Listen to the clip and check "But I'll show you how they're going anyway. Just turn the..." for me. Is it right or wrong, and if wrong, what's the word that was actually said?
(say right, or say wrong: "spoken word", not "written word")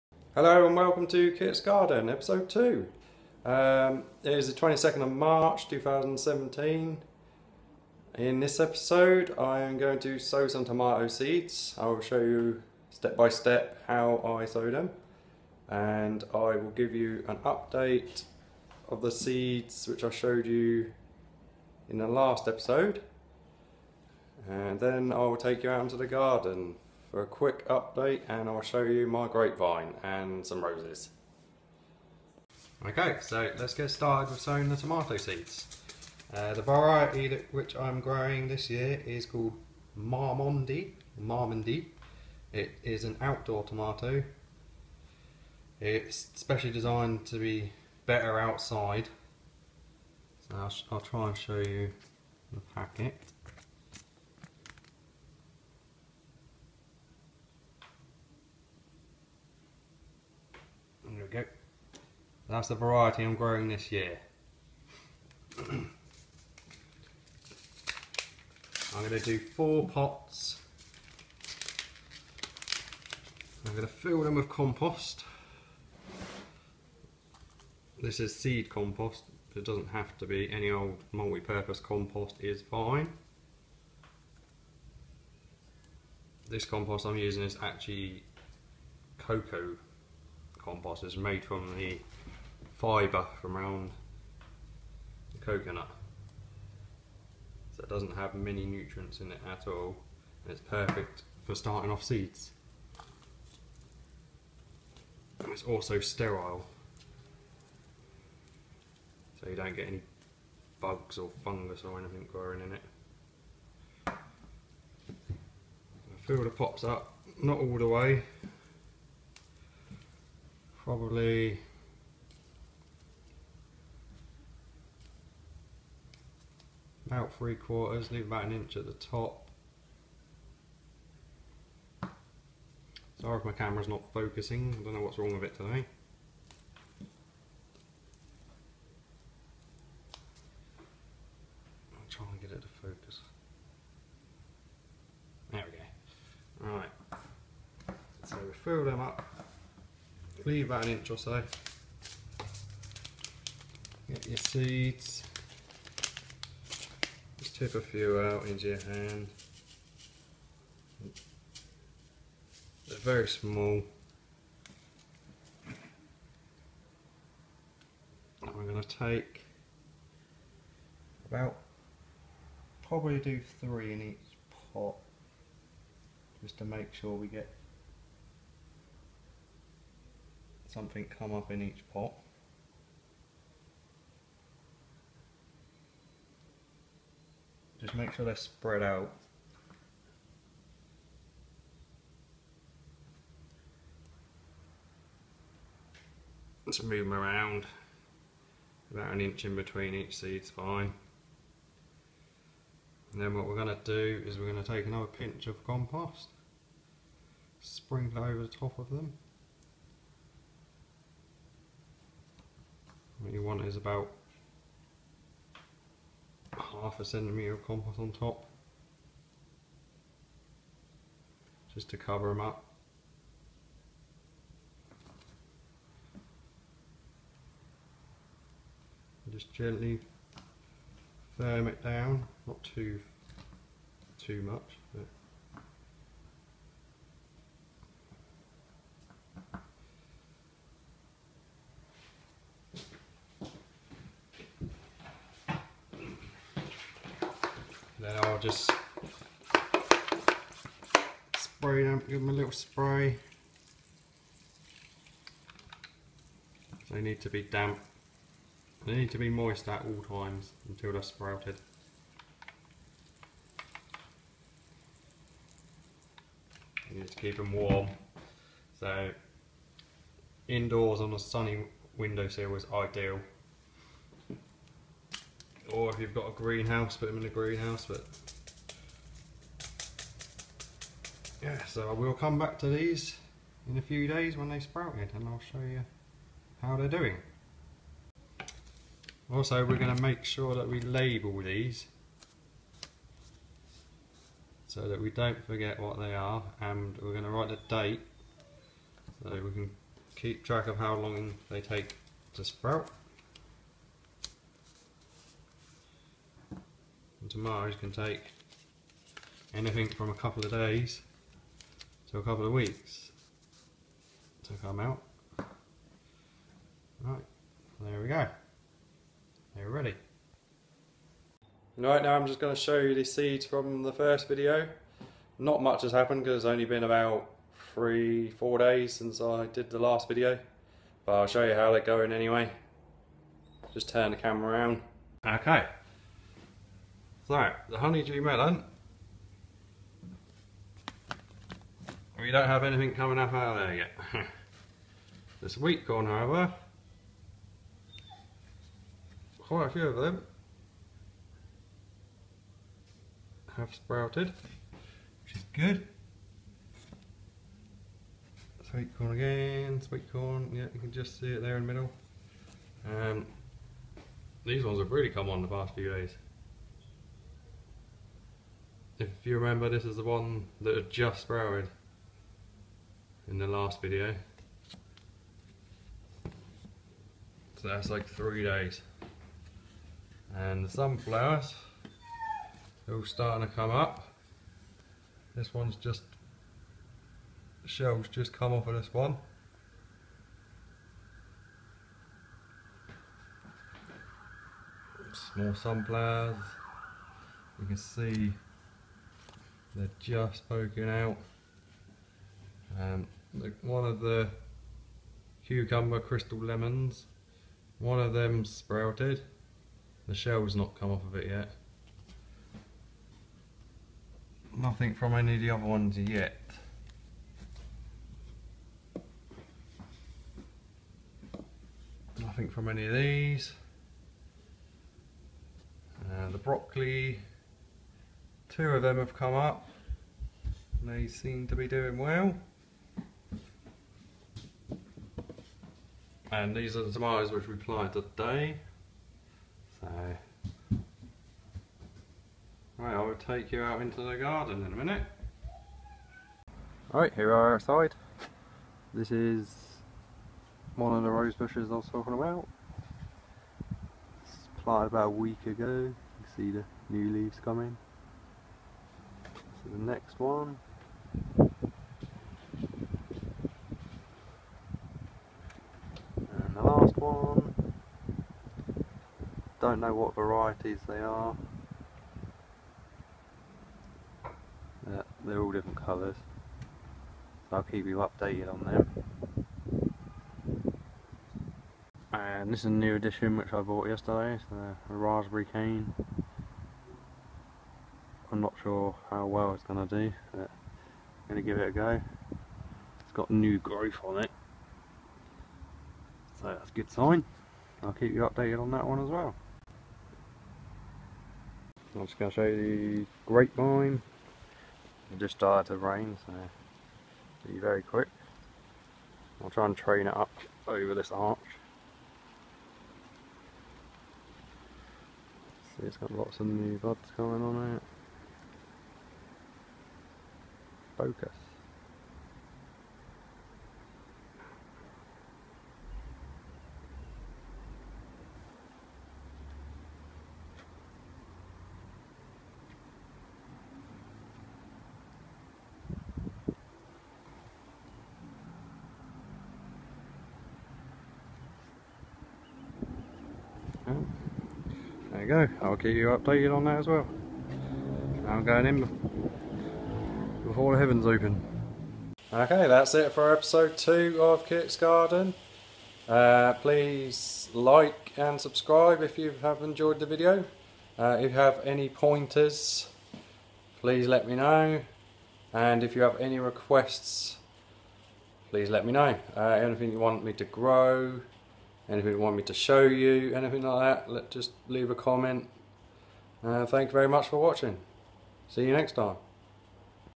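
right.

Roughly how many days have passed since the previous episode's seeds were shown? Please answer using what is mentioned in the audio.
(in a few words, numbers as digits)
3 to 4 days.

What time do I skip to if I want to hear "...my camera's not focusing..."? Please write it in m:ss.
2:13.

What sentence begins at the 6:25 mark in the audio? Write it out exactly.
This one's just, the shell's just come off of this one.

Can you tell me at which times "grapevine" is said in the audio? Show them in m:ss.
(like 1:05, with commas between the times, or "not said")
0:29, 8:23.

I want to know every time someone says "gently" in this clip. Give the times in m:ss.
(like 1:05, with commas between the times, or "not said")
3:49.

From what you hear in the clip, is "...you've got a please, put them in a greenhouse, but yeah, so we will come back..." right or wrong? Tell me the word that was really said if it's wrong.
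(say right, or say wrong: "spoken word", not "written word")
wrong: "greenhouse", not "please".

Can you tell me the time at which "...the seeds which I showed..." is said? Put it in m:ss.
0:19.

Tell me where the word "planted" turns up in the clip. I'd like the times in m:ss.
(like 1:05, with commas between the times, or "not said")
7:17, 7:34.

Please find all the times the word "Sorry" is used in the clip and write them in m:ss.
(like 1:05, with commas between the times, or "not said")
2:13.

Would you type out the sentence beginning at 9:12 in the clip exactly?
Okay, that's it for episode 2 of Kit's Garden.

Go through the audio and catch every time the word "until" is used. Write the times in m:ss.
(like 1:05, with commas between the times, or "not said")
4:20.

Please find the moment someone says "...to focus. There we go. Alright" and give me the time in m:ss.
2:22.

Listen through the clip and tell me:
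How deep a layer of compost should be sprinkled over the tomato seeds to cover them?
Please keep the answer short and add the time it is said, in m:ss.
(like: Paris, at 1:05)
half a centimetre, at 3:36.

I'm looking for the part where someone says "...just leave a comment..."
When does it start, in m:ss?
9:34.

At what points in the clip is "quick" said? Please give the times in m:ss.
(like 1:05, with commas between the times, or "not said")
0:27, 8:27.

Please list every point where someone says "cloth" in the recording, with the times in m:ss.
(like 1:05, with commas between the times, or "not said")
not said.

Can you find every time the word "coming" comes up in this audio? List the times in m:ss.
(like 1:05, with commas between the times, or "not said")
5:42, 7:37, 8:37.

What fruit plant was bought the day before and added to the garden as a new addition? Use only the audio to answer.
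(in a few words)
raspberry cane.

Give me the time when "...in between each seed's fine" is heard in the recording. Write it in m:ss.
3:19.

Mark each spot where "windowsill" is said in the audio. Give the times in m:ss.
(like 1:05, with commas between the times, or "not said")
4:31.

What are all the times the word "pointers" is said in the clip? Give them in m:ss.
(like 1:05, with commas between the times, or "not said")
9:21.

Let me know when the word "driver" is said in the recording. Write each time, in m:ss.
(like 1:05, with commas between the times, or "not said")
not said.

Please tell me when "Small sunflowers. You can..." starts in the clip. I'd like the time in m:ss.
6:35.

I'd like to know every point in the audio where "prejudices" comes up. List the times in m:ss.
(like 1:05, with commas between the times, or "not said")
not said.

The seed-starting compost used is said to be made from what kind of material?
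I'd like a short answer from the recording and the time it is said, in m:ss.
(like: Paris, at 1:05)
cocoa compost, at 1:29.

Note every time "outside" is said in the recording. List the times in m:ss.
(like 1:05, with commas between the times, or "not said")
0:48, 7:27.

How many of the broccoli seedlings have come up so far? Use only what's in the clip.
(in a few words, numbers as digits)
2.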